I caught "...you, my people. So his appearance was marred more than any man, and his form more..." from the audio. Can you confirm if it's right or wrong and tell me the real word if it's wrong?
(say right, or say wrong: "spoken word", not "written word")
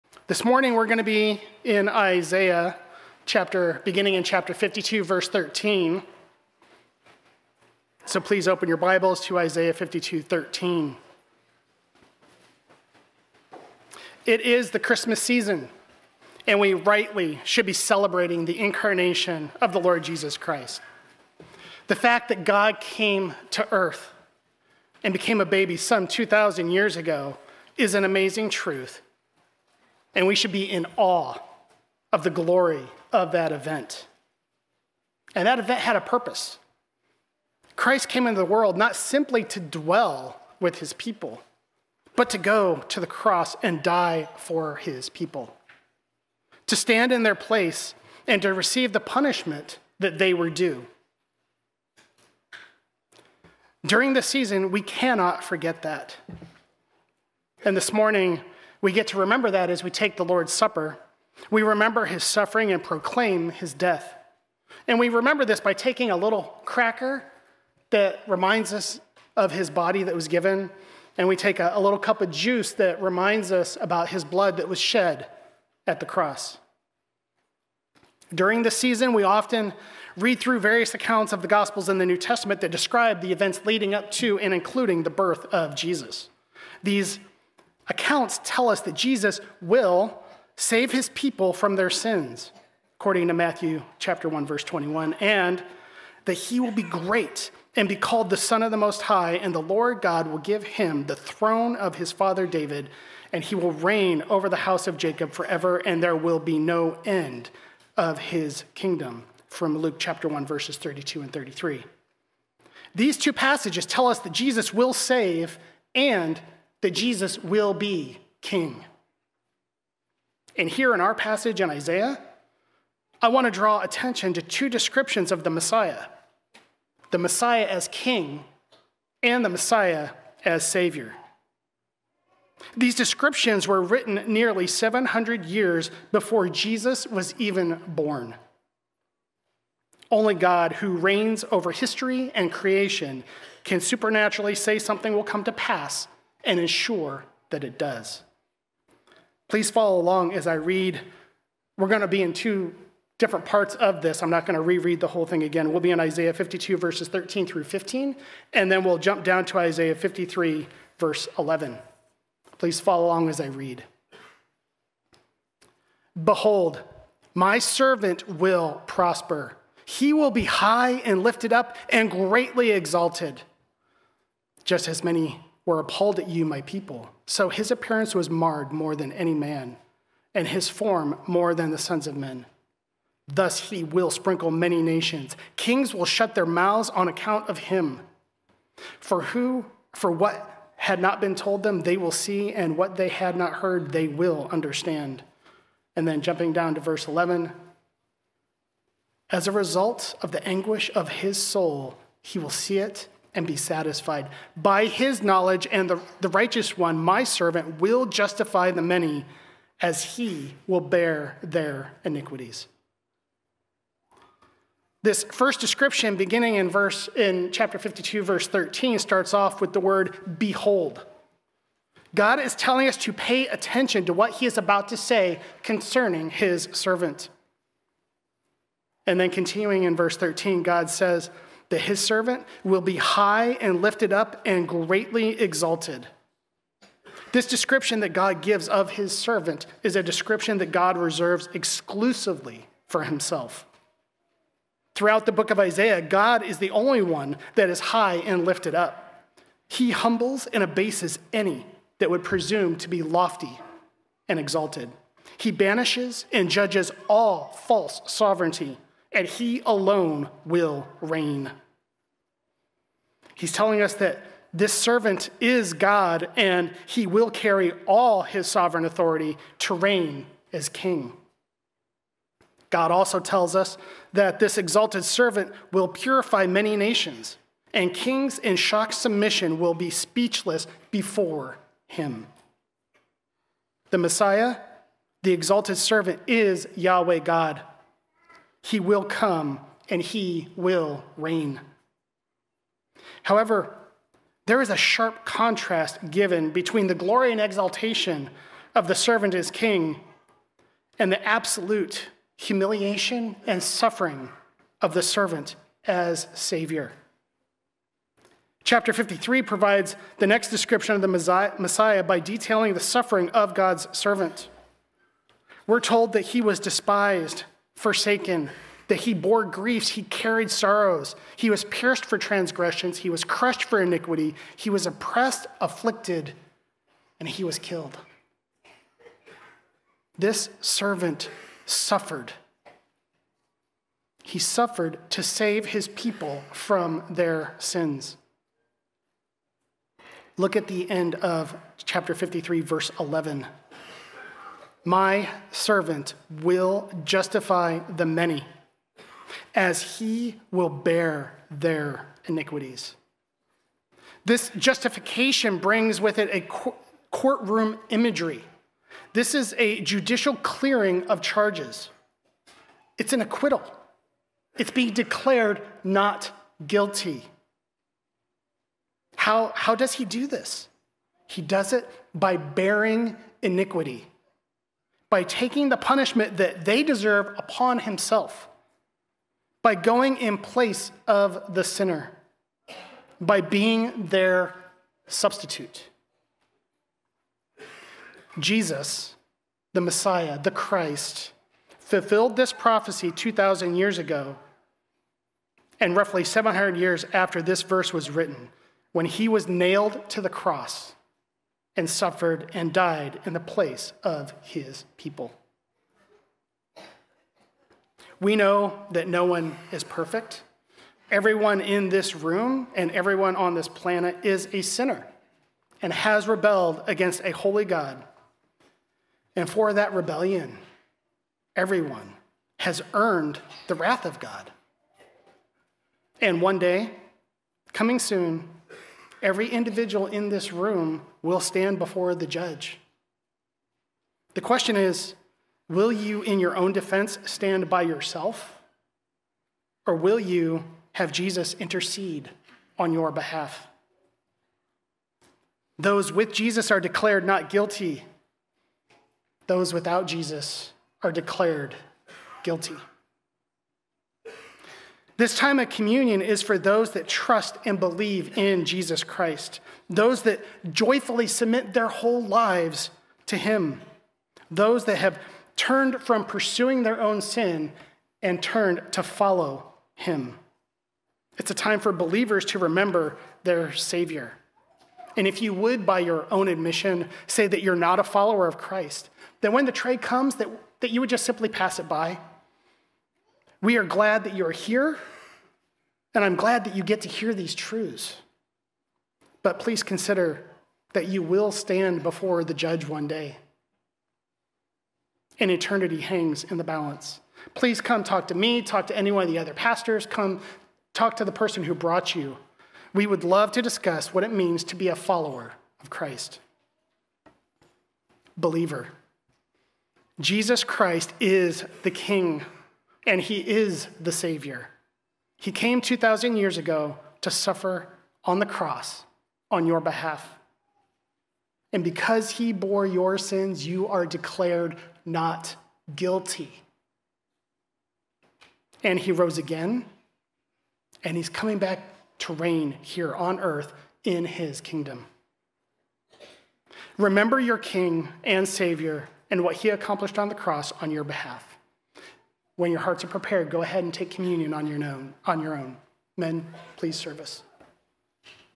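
right.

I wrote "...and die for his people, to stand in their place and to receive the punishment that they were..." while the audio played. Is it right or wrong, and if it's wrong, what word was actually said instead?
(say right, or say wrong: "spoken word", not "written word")
right.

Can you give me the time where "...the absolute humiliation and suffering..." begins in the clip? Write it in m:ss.
5:01.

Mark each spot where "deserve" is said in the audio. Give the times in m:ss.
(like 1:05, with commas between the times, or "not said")
6:16.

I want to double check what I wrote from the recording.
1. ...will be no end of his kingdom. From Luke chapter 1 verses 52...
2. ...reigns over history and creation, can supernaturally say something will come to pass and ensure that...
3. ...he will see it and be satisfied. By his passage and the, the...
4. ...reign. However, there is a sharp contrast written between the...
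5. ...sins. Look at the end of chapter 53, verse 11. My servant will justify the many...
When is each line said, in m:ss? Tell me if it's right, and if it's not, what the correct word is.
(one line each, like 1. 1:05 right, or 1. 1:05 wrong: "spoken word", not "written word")
1. 1:46 wrong: "32", not "52"
2. 2:20 right
3. 3:22 wrong: "knowledge", not "passage"
4. 4:51 wrong: "given", not "written"
5. 5:37 right.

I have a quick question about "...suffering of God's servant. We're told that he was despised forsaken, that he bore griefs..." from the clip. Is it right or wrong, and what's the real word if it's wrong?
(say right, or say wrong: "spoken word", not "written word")
right.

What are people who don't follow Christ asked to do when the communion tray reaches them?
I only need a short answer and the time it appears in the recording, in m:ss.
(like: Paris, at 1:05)
Pass it by, at 8:01.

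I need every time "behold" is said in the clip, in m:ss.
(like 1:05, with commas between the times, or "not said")
2:46, 3:40.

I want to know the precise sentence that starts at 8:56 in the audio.
Remember your King and Savior and what he accomplished on the cross on your behalf.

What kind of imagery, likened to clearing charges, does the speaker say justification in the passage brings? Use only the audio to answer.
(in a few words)
Courtroom imagery.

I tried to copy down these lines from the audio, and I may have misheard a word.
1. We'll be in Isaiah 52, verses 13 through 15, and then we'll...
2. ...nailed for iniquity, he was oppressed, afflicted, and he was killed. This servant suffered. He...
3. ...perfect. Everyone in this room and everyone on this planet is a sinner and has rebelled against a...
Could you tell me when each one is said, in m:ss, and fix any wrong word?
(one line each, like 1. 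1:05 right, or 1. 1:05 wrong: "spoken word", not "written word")
1. 2:35 right
2. 5:23 wrong: "crushed", not "nailed"
3. 6:49 right.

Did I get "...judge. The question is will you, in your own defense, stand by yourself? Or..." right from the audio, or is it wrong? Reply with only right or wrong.
right.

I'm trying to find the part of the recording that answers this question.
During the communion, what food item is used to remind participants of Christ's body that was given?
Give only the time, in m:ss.
1:06.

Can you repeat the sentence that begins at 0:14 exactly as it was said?
It is the Christmas season, and we rightly should be celebrating the incarnation of the Lord Jesus Christ.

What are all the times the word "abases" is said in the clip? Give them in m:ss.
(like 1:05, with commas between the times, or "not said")
4:10.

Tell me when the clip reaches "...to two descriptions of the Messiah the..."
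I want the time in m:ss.
2:04.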